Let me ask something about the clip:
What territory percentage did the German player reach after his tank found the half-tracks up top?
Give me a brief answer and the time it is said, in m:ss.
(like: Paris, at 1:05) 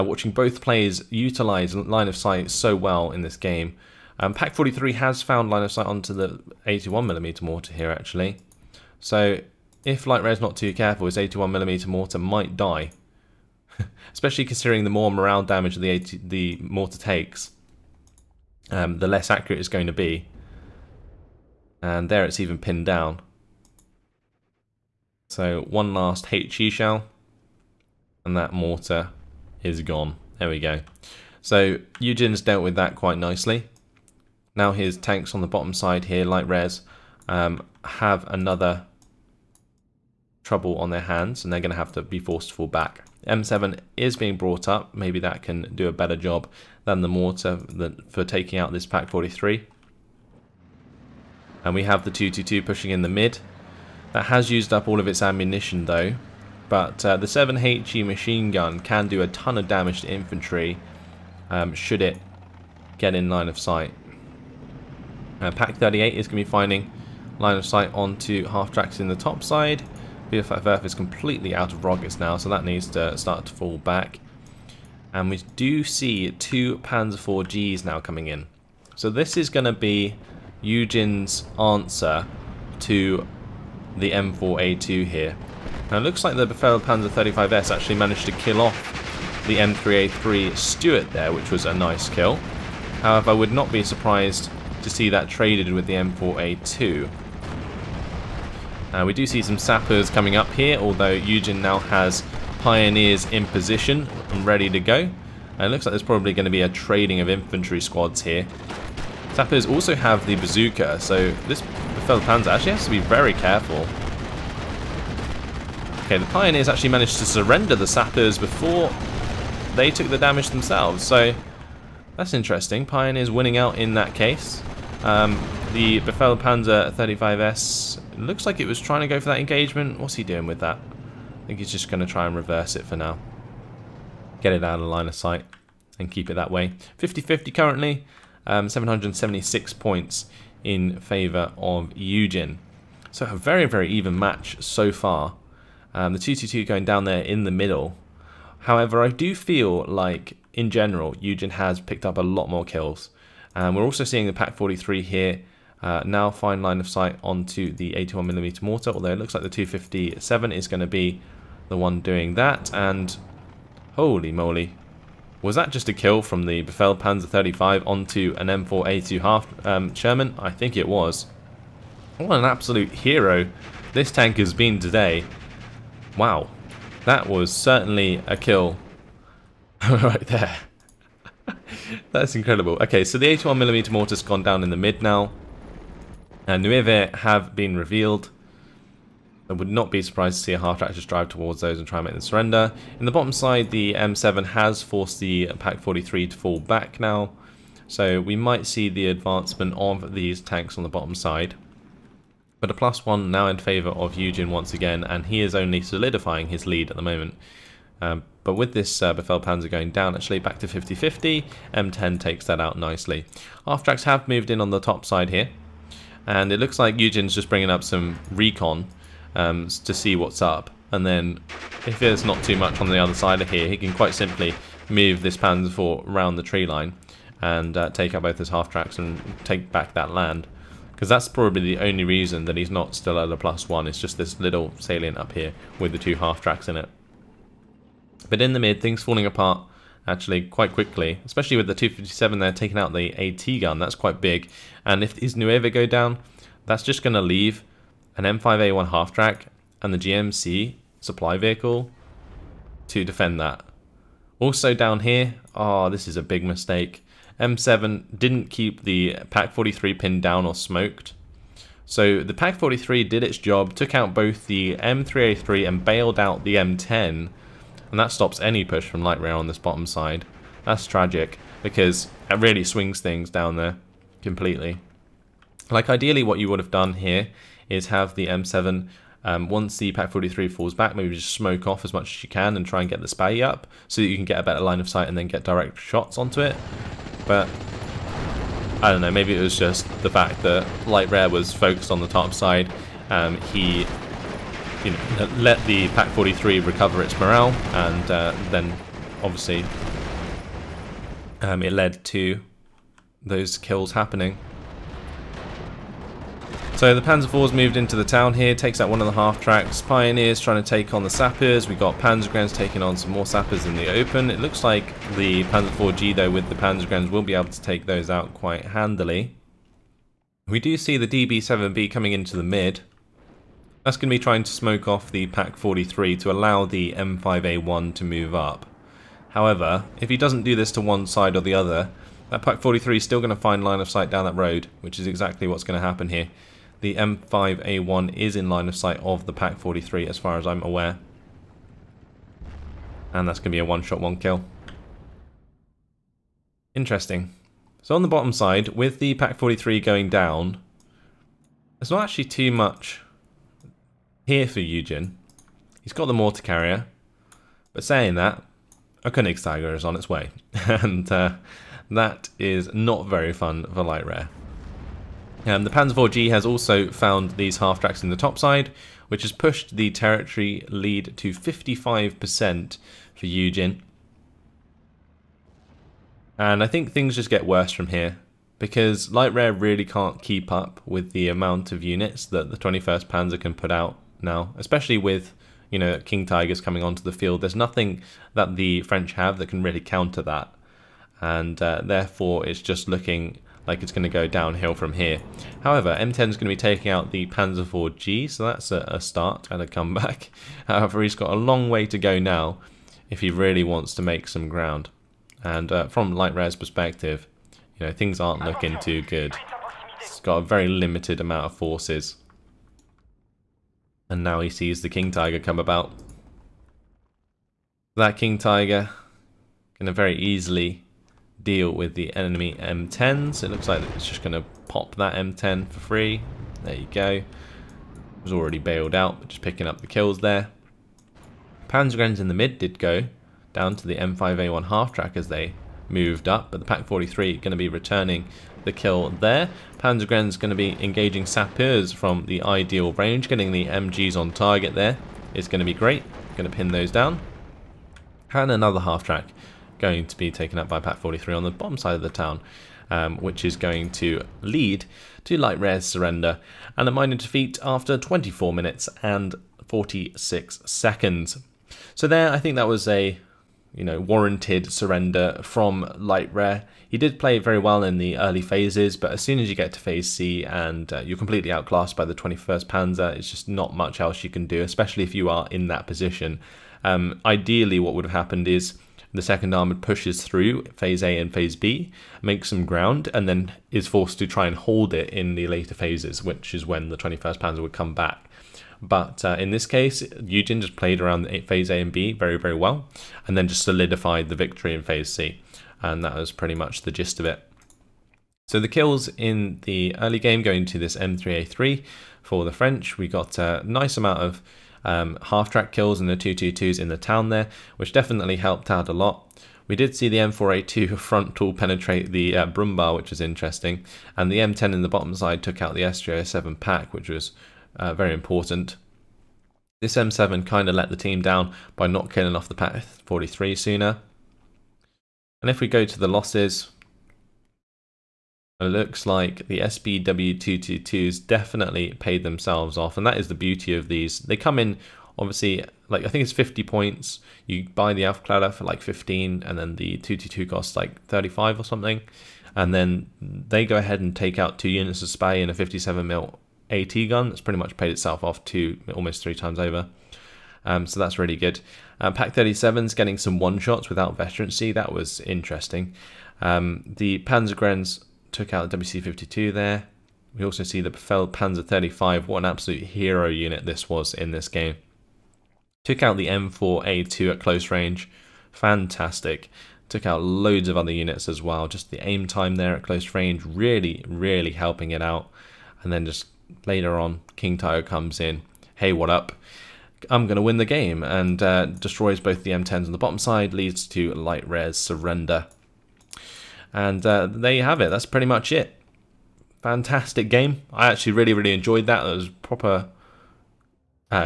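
55%, at 6:11.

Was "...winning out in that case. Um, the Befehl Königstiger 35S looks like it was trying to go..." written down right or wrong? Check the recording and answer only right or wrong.
wrong.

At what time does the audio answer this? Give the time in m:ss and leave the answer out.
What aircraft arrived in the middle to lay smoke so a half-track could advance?
5:21.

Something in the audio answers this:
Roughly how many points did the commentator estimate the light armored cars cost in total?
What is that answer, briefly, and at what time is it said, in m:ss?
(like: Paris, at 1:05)
50, at 8:56.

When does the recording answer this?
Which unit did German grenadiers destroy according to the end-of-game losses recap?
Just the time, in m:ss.
9:18.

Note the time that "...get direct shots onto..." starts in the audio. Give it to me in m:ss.
4:45.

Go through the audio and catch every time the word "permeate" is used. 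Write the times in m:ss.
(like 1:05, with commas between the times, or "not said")
not said.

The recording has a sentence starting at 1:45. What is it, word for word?
And uh, it looks like there's probably going to be a trading of infantry squads here.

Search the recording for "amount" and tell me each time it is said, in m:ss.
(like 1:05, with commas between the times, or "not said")
6:21, 6:51, 8:23.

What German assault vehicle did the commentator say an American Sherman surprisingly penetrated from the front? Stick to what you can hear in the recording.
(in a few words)
Brumbar.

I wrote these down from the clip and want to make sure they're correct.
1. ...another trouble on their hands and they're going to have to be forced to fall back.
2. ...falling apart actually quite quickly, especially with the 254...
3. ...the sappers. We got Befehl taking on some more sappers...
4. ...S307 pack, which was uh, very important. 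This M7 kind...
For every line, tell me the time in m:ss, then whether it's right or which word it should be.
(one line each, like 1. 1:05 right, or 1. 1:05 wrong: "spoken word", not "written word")
1. 0:38 right
2. 3:59 wrong: "257", not "254"
3. 5:11 wrong: "Panzergrens", not "Befehl"
4. 8:35 right.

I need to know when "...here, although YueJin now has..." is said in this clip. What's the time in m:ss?
1:40.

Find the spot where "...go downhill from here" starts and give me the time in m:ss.
6:34.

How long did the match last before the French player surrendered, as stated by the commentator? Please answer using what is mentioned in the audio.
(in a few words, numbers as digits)
24 minutes and 46 seconds.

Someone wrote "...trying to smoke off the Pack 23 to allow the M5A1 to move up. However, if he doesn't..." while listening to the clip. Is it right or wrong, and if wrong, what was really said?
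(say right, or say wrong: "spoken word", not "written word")
wrong: "43", not "23".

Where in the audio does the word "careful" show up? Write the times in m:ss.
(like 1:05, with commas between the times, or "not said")
0:10, 1:53.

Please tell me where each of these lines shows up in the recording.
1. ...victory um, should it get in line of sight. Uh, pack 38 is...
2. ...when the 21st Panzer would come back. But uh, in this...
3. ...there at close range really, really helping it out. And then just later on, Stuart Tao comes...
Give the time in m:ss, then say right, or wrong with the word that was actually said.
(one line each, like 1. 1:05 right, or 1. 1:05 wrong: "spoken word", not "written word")
1. 1:00 wrong: "infantry", not "victory"
2. 8:06 right
3. 9:32 wrong: "King", not "Stuart".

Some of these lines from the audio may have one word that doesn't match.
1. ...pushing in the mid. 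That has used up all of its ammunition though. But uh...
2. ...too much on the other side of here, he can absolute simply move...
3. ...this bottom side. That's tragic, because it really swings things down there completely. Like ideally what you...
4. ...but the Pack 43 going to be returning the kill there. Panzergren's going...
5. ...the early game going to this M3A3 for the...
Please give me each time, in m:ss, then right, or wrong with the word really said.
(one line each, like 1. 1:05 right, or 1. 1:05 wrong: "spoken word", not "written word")
1. 0:52 right
2. 3:42 wrong: "quite", not "absolute"
3. 4:29 right
4. 7:16 right
5. 8:19 right.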